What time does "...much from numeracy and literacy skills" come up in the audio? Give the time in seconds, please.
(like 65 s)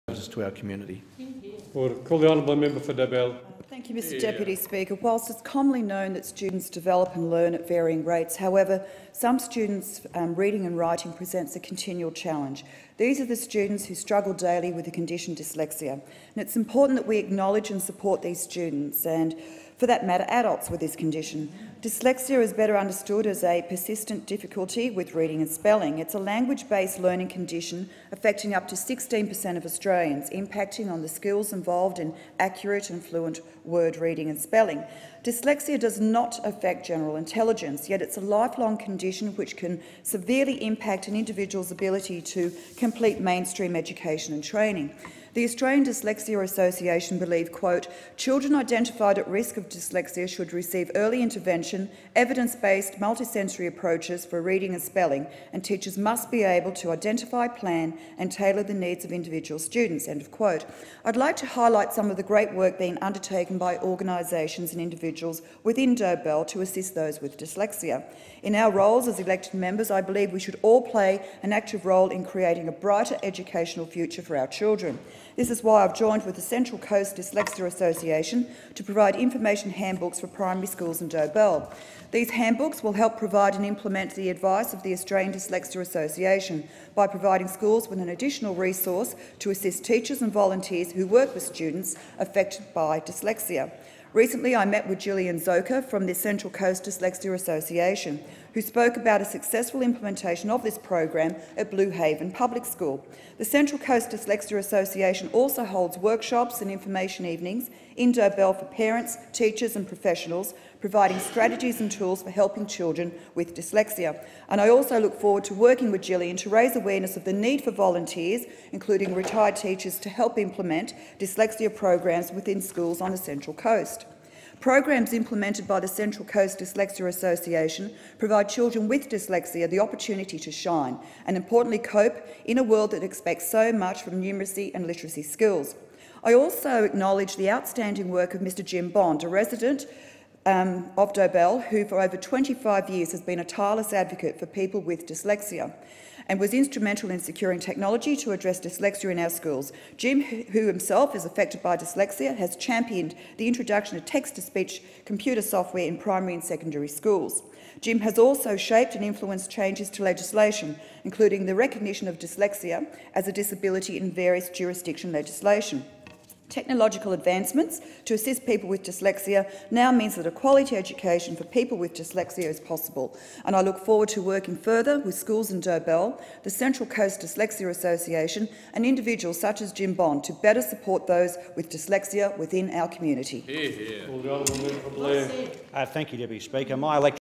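133 s.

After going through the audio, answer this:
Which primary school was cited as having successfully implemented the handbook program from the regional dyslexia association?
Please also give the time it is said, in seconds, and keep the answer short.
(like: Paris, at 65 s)
Blue Haven Public School, at 101 s.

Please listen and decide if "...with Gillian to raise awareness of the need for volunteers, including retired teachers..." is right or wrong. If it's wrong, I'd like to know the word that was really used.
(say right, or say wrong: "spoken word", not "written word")
right.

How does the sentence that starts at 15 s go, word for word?
And it's important that we acknowledge and support these students.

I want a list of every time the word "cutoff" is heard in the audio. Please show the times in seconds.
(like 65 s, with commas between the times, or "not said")
not said.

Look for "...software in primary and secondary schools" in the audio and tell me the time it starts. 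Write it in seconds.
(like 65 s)
155 s.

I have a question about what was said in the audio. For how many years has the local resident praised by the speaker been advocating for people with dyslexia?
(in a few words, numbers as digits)
25.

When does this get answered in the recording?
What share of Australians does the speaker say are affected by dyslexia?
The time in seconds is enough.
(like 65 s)
28 s.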